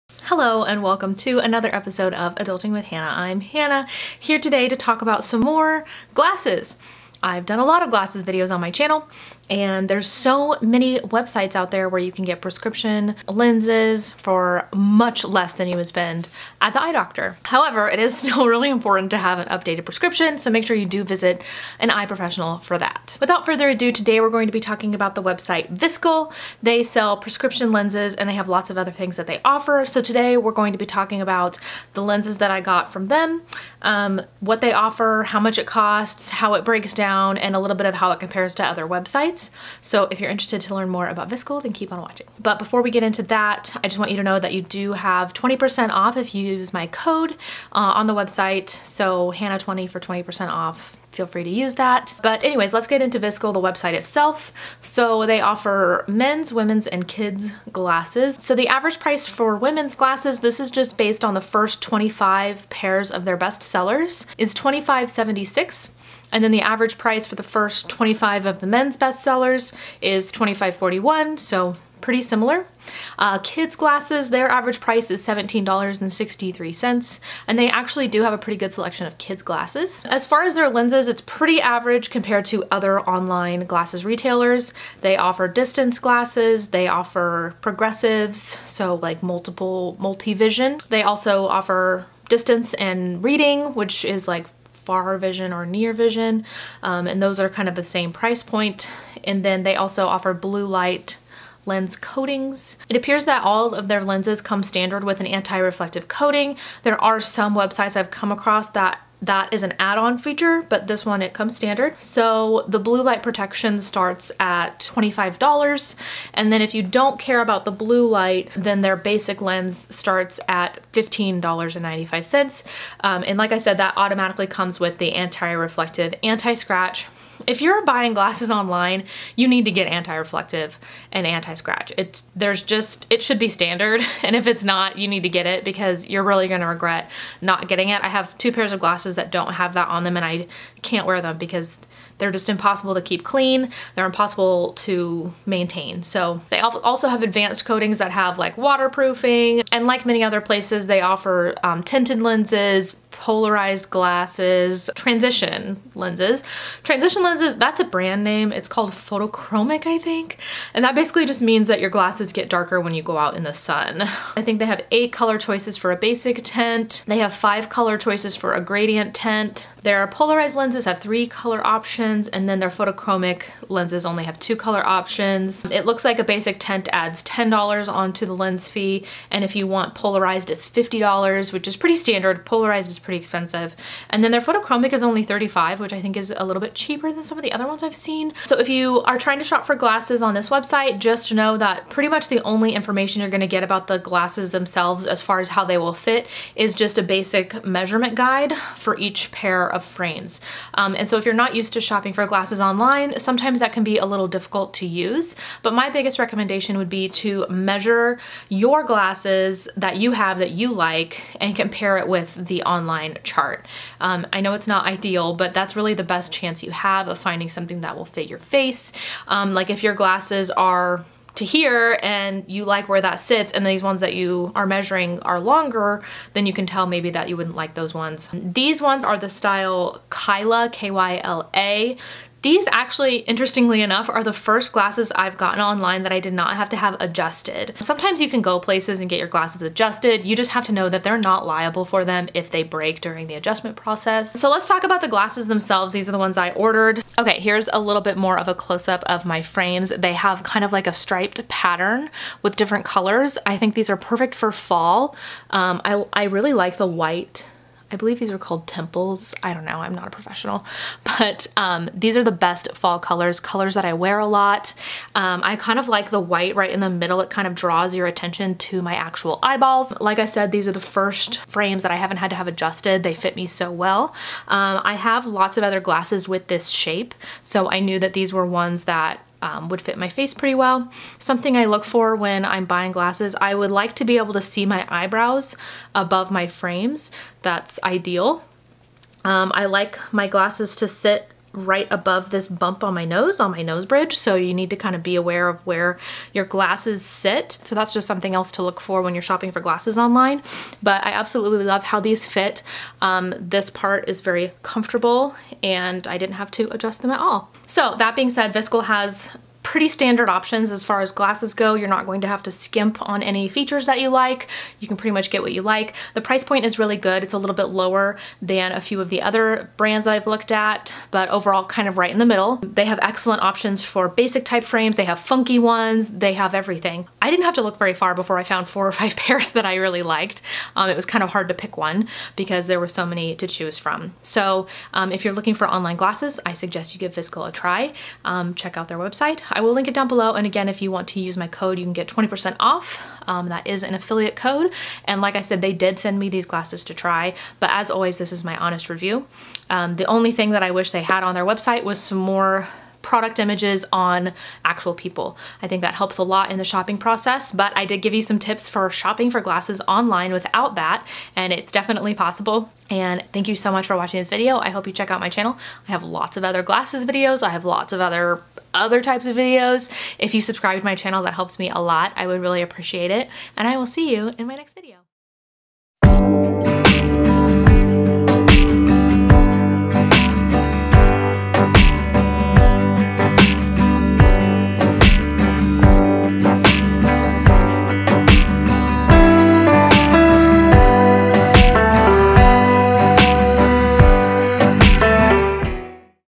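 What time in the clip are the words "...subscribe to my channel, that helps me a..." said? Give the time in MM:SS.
06:10.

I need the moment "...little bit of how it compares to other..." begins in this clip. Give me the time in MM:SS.
00:37.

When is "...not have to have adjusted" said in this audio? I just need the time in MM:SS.
03:56.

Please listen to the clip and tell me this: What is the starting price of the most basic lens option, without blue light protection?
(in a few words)
$15.95.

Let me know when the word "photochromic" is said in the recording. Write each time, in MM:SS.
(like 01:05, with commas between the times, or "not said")
02:38, 02:52, 03:04.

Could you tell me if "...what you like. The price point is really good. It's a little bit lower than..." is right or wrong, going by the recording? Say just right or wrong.
right.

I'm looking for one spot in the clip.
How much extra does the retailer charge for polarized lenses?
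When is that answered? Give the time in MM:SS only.
03:00.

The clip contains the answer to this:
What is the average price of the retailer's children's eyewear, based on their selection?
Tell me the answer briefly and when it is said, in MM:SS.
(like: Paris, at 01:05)
$17.63, at 01:15.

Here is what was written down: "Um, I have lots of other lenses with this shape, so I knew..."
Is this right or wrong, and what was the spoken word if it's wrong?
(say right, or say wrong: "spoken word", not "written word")
wrong: "glasses", not "lenses".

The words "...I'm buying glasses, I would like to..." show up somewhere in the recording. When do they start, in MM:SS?
04:42.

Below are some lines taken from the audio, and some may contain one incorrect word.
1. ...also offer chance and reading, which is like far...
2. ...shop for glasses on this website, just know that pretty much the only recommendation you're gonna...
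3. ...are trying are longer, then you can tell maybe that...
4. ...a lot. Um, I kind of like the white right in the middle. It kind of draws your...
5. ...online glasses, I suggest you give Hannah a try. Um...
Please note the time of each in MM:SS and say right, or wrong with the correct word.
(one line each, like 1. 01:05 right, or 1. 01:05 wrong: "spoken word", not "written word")
1. 01:31 wrong: "distance", not "chance"
2. 03:09 wrong: "information", not "recommendation"
3. 03:44 wrong: "measuring", not "trying"
4. 04:24 right
5. 05:35 wrong: "Viskle", not "Hannah".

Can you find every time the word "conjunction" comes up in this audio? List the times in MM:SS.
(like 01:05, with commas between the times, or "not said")
not said.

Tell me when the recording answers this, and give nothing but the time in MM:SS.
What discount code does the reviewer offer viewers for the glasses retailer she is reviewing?
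00:49.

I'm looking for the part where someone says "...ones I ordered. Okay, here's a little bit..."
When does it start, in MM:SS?
04:06.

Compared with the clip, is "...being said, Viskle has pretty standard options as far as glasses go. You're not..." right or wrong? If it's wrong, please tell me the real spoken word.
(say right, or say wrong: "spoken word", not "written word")
right.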